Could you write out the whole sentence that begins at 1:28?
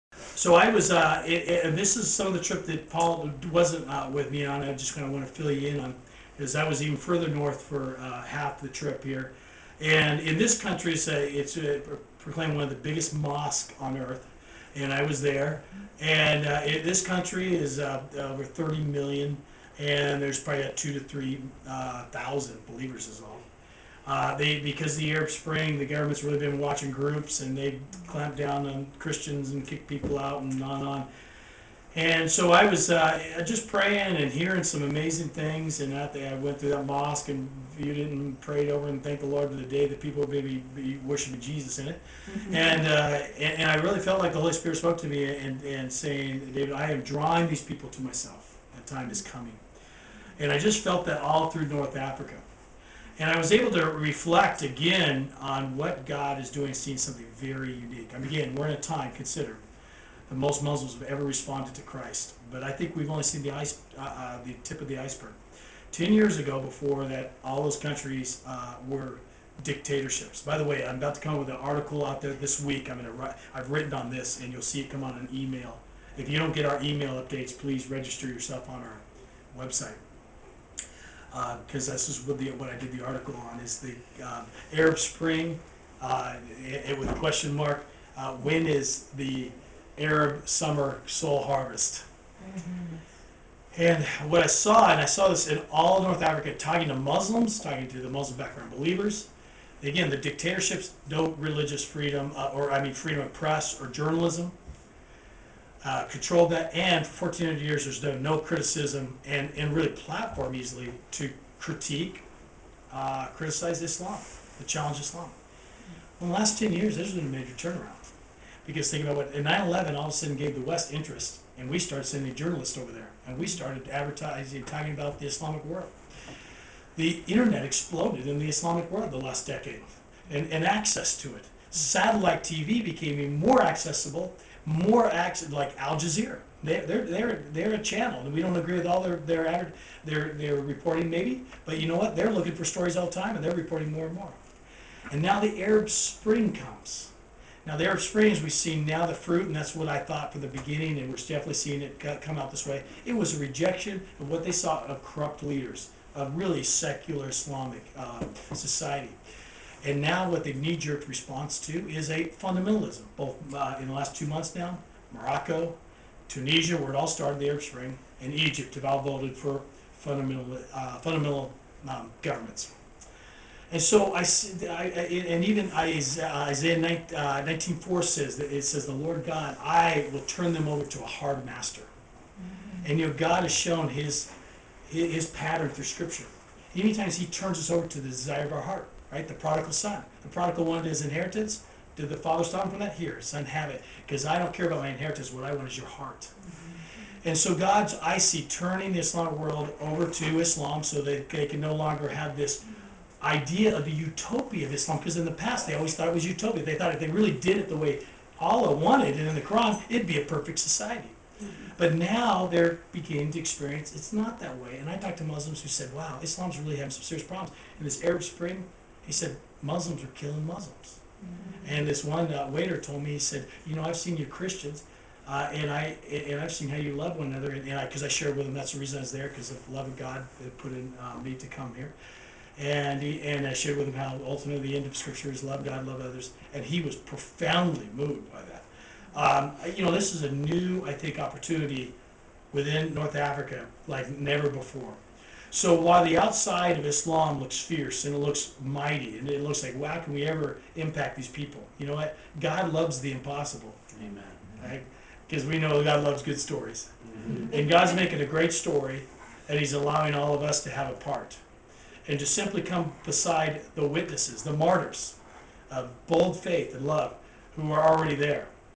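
Uh, when is the Arab summer soul harvest?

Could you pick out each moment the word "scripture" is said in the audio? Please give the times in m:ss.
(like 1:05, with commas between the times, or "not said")
3:05, 3:54.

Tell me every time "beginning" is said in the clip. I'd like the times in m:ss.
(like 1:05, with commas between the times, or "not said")
2:30, 3:32.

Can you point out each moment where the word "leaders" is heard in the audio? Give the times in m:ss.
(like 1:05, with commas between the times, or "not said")
2:35.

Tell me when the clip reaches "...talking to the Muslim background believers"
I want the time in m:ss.
1:37.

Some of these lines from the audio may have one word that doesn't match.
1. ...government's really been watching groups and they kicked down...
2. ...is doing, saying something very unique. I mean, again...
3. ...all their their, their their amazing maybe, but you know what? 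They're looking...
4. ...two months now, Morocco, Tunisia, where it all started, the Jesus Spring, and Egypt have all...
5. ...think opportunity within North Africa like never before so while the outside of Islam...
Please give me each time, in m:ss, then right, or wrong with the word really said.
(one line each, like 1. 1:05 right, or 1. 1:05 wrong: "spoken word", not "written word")
1. 0:25 wrong: "clamped", not "kicked"
2. 0:56 wrong: "seeing", not "saying"
3. 2:18 wrong: "reporting", not "amazing"
4. 2:44 wrong: "Arab", not "Jesus"
5. 4:00 right.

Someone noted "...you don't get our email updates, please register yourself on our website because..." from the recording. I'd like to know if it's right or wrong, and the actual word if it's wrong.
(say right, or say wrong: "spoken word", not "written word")
right.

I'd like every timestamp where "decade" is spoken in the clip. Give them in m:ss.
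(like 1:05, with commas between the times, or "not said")
2:09.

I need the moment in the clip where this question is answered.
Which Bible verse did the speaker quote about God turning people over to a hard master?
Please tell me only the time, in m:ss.
2:55.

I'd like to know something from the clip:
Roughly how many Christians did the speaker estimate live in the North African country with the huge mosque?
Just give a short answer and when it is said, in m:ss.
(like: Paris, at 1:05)
2,000 to 3,000, at 0:20.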